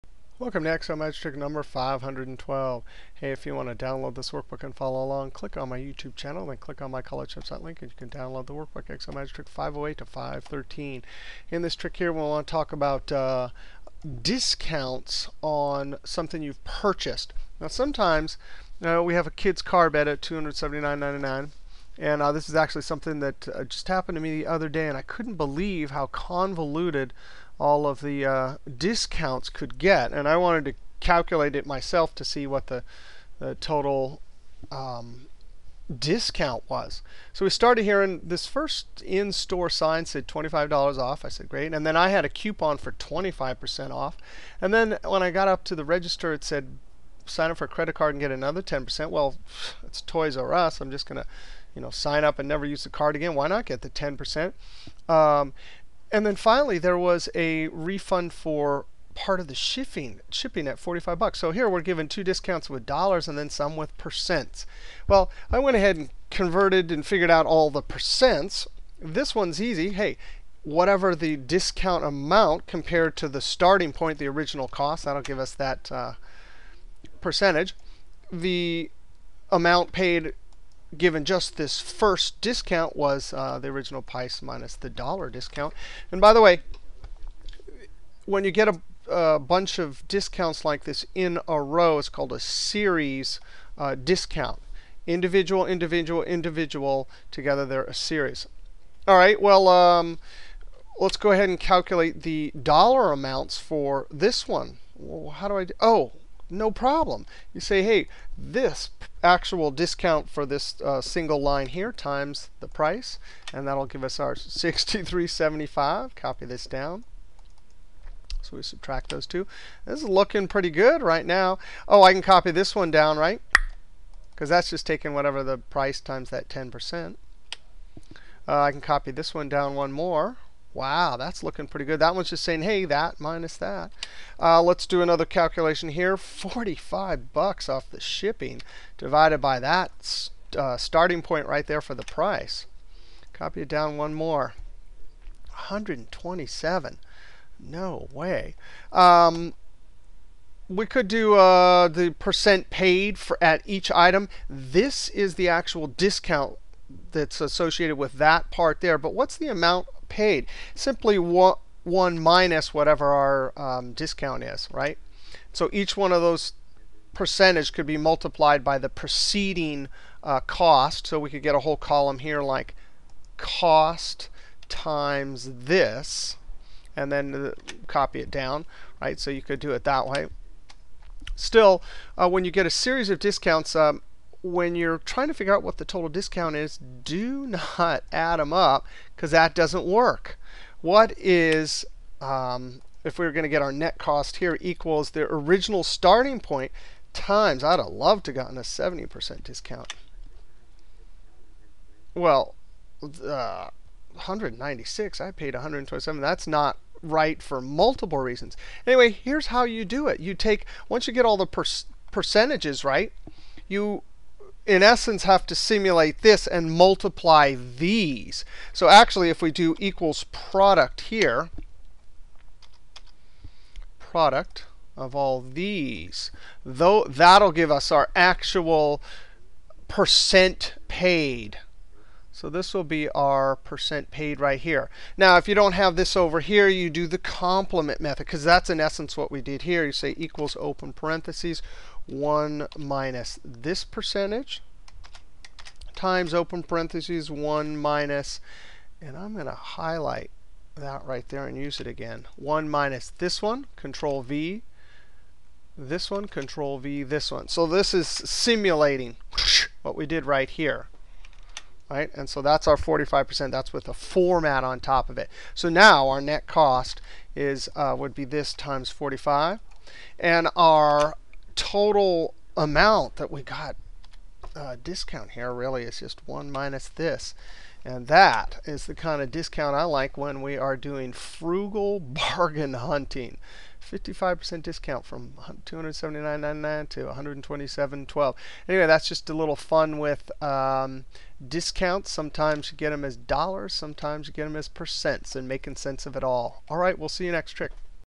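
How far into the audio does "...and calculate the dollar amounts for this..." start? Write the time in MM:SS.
01:41.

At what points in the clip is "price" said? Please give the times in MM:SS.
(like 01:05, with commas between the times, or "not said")
01:24, 01:52, 02:05, 02:22.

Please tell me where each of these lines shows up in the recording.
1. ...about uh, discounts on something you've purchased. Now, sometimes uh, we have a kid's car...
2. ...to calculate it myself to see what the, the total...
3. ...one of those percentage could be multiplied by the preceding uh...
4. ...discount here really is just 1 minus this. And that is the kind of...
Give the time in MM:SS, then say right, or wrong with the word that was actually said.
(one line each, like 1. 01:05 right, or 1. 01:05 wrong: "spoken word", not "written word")
1. 00:12 right
2. 00:30 right
3. 02:45 right
4. 04:34 right.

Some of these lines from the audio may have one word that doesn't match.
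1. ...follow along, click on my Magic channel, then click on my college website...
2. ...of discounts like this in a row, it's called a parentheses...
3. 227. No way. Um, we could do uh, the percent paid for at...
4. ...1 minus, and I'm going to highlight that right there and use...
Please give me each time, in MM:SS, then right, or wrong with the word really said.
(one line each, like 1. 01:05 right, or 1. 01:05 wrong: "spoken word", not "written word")
1. 00:04 wrong: "YouTube", not "Magic"
2. 01:29 wrong: "series", not "parentheses"
3. 02:25 wrong: "127", not "227"
4. 04:07 right.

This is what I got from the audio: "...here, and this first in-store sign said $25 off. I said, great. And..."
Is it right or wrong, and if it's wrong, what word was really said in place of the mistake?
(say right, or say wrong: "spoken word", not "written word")
right.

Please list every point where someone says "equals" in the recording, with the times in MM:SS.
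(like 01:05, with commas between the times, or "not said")
03:14, 03:39, 04:00.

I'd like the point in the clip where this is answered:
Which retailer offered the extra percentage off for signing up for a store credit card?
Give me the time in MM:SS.
00:50.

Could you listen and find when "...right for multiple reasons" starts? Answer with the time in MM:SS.
03:27.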